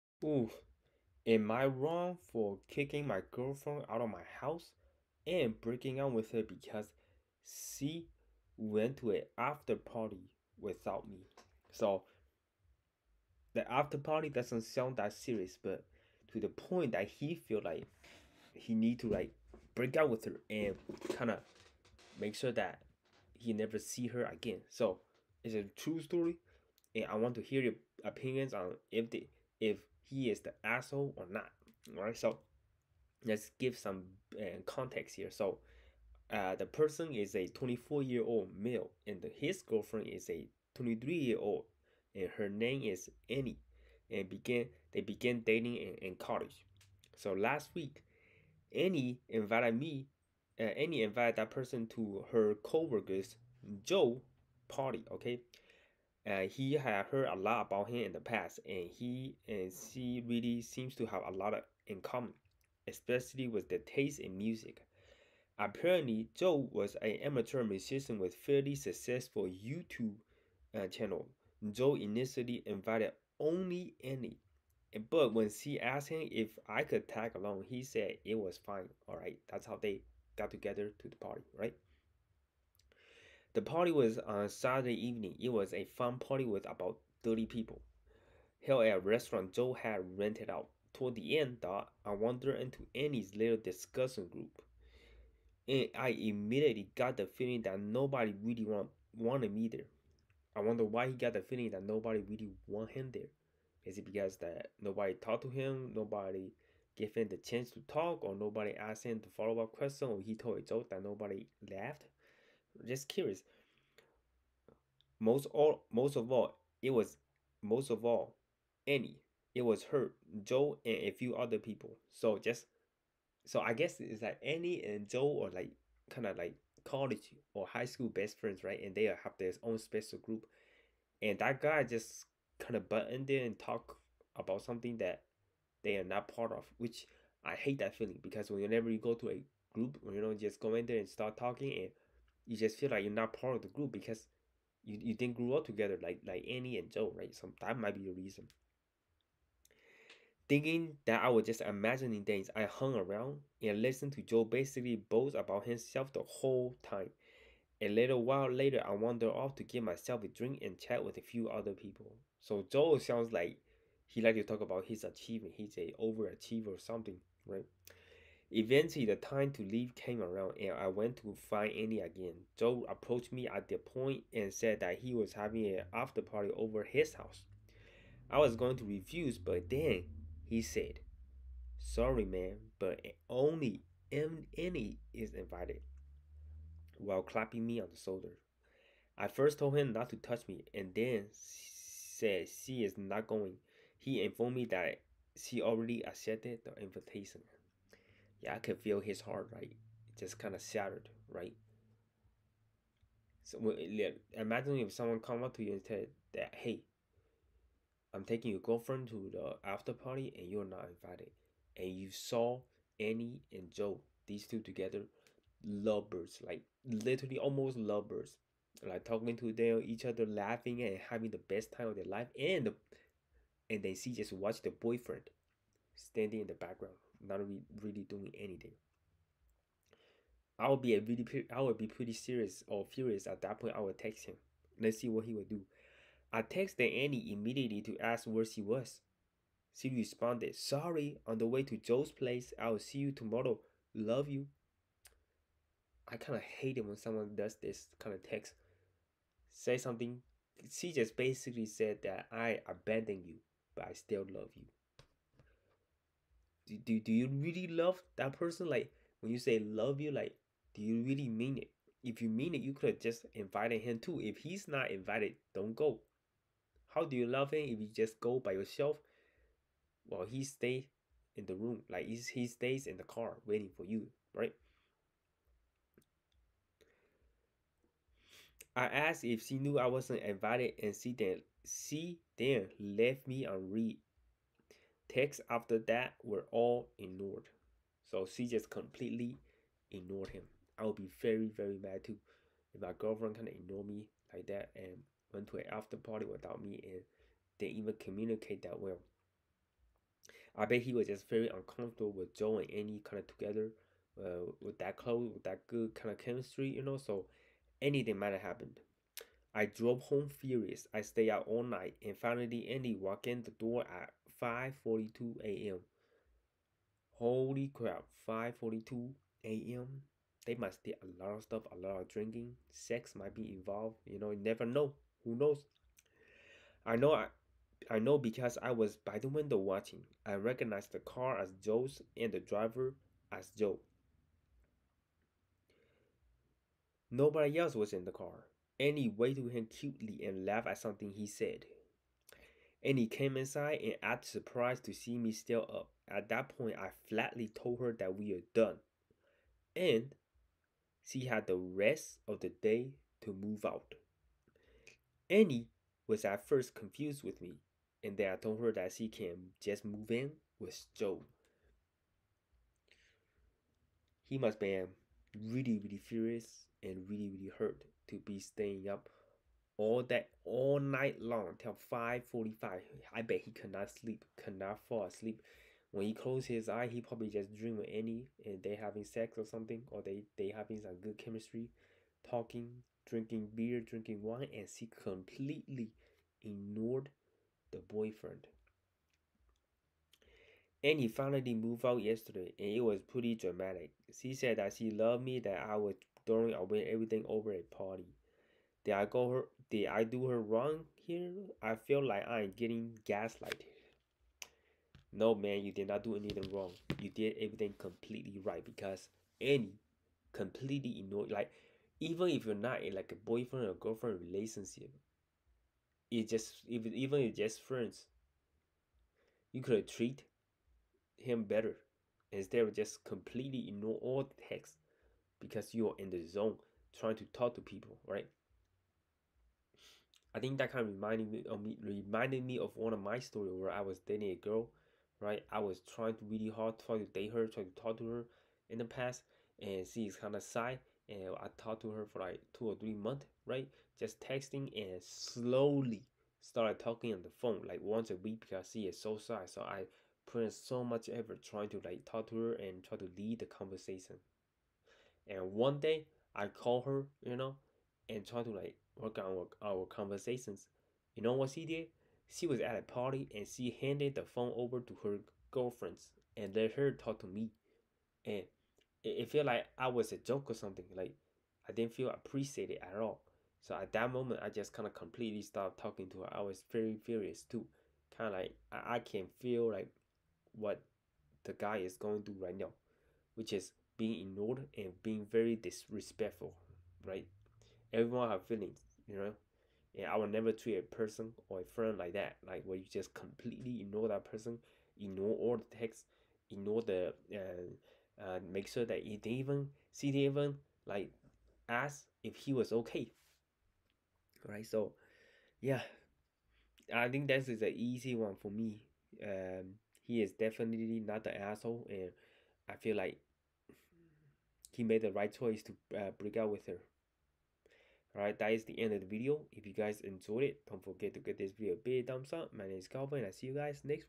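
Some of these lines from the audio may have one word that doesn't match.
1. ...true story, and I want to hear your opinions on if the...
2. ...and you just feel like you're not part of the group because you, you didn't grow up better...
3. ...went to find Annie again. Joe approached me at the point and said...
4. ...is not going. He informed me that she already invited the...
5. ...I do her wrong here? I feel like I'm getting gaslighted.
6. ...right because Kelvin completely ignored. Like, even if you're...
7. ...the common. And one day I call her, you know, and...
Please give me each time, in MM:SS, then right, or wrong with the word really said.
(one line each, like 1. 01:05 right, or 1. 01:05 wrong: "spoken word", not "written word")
1. 00:25 right
2. 02:21 wrong: "together", not "better"
3. 02:50 right
4. 03:12 wrong: "accepted", not "invited"
5. 06:39 right
6. 06:48 wrong: "Annie", not "Kelvin"
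7. 07:33 wrong: "conversation", not "common".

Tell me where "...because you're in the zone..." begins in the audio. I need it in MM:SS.
07:05.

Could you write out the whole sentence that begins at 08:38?
Alright, that is the end of the video.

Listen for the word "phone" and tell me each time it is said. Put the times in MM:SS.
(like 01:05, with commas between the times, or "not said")
07:27, 07:44.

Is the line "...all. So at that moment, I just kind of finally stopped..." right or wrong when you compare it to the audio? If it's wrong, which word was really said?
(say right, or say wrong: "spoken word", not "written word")
wrong: "completely", not "finally".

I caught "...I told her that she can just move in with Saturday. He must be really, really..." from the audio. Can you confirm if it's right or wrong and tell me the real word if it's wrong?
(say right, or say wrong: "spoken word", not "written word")
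wrong: "Joe", not "Saturday".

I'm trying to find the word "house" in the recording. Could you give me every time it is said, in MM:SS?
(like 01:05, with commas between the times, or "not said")
00:04, 02:57.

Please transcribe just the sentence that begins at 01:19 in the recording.
All right, that's how they got together to the party, right?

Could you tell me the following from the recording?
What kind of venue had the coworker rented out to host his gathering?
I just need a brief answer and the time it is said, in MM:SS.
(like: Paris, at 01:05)
A restaurant, at 01:29.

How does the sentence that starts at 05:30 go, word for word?
I recognized the car as Joe's and the driver as Joe.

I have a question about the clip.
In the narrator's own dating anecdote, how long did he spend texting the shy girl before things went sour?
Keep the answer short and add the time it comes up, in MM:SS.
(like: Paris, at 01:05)
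2 or 3 months, at 07:22.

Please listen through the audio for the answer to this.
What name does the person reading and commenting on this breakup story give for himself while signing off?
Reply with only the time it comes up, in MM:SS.
08:42.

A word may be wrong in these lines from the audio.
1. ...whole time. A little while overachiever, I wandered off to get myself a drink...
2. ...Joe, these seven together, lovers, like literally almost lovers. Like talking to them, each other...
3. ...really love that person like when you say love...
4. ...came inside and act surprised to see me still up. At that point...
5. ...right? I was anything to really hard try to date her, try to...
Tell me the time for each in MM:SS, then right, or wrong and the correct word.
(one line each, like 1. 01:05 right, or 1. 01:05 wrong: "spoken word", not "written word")
1. 02:36 wrong: "later", not "overachiever"
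2. 03:33 wrong: "two", not "seven"
3. 04:17 right
4. 05:43 right
5. 07:15 wrong: "trying", not "anything".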